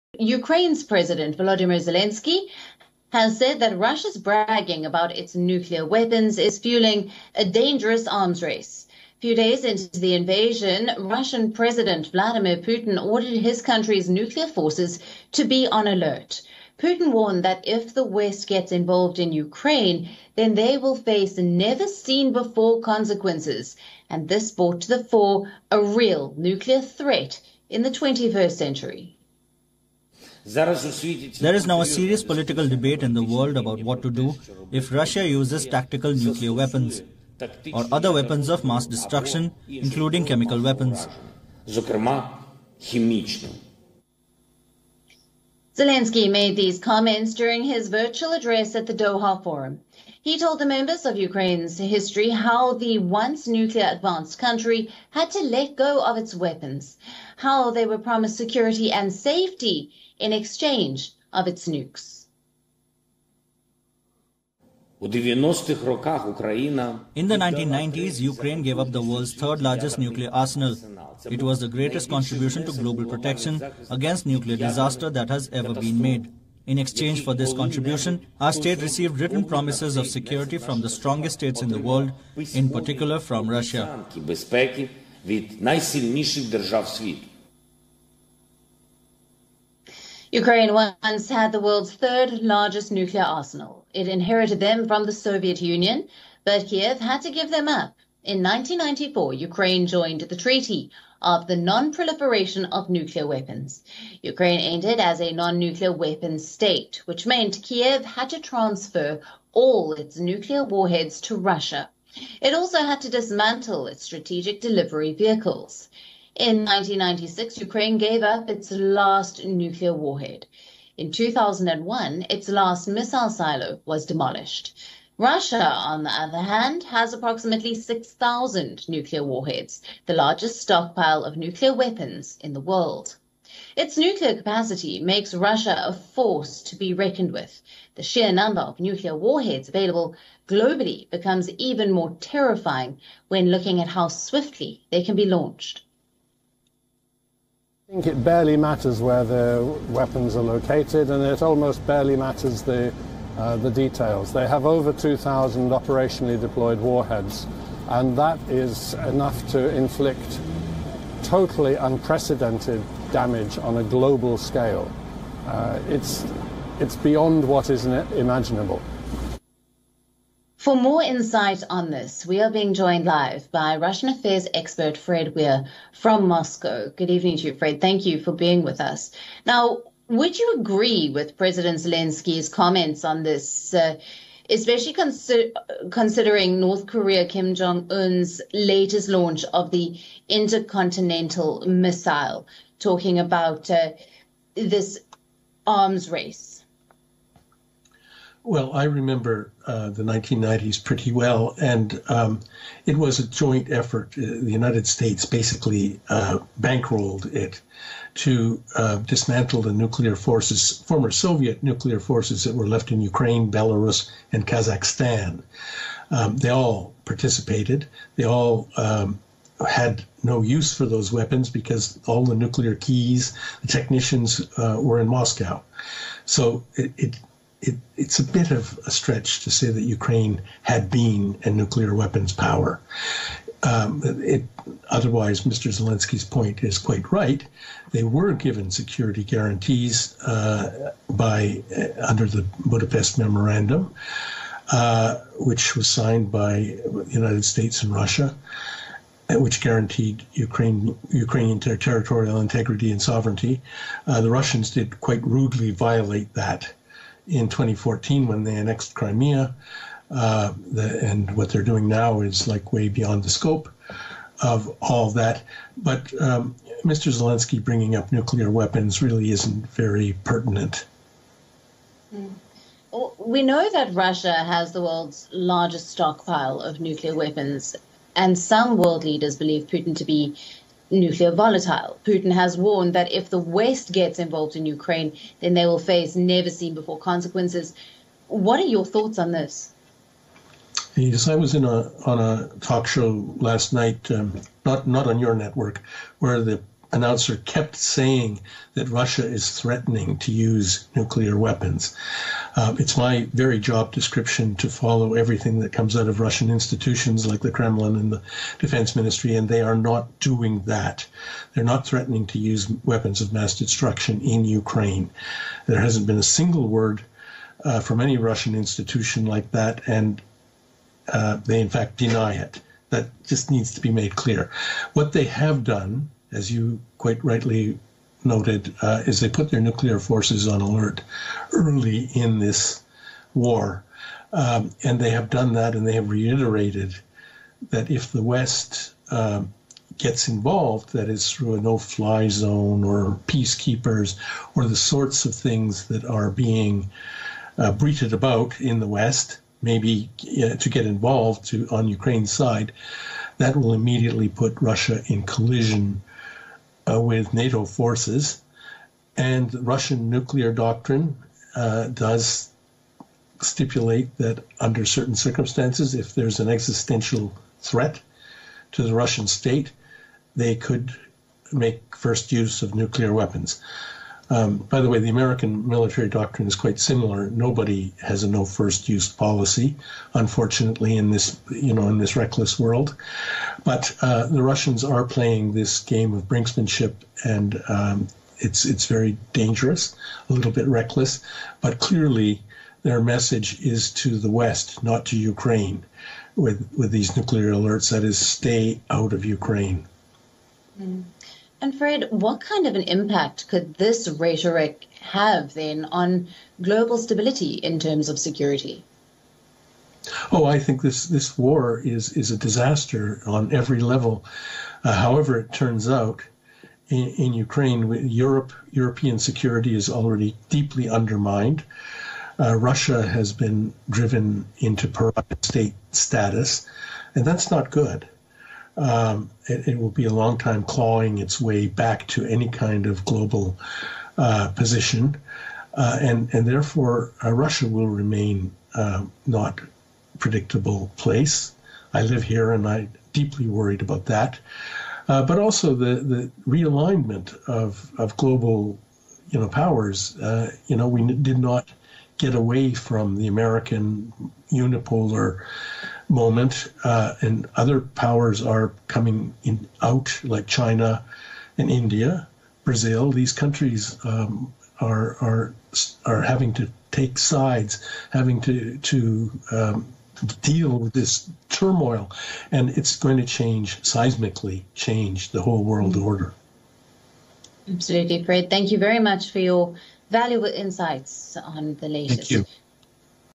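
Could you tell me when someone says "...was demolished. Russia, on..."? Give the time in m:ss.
2:03.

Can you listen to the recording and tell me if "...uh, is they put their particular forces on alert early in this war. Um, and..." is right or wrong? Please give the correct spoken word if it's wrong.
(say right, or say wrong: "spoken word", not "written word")
wrong: "nuclear", not "particular".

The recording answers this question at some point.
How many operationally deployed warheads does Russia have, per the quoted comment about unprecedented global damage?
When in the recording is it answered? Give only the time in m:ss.
2:34.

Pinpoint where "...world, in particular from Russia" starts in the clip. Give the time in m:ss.
1:21.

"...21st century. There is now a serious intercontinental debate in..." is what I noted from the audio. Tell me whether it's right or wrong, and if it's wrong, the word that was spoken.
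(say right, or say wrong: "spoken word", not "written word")
wrong: "political", not "intercontinental".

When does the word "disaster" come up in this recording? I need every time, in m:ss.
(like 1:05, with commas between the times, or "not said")
1:14, 6:52.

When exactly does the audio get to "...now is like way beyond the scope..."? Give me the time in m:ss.
4:21.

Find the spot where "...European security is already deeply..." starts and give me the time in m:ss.
6:58.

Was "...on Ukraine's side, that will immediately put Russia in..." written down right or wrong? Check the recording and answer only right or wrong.
right.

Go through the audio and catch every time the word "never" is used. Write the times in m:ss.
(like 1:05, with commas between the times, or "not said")
0:21, 4:46.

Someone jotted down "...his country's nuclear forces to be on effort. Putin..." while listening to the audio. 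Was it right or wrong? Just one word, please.
wrong.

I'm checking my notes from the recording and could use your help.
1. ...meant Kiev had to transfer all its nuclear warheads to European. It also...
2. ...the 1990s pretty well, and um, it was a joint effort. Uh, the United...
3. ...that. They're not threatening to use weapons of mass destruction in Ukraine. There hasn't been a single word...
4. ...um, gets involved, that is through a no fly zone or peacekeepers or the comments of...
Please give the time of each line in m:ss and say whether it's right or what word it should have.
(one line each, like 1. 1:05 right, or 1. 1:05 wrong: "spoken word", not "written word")
1. 1:47 wrong: "Russia", not "European"
2. 3:19 right
3. 5:10 right
4. 5:39 wrong: "sorts", not "comments".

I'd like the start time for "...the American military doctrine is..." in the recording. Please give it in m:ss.
6:14.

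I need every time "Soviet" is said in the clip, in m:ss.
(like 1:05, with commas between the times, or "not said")
1:35, 3:31.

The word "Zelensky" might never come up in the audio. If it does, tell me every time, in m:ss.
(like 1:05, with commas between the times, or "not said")
0:01, 0:41, 3:01, 3:55, 4:27.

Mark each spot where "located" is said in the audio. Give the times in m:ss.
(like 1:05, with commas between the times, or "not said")
2:30.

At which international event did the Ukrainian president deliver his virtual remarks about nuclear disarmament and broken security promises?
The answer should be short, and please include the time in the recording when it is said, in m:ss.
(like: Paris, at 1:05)
Doha Forum, at 0:48.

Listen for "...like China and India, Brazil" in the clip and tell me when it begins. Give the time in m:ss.
7:40.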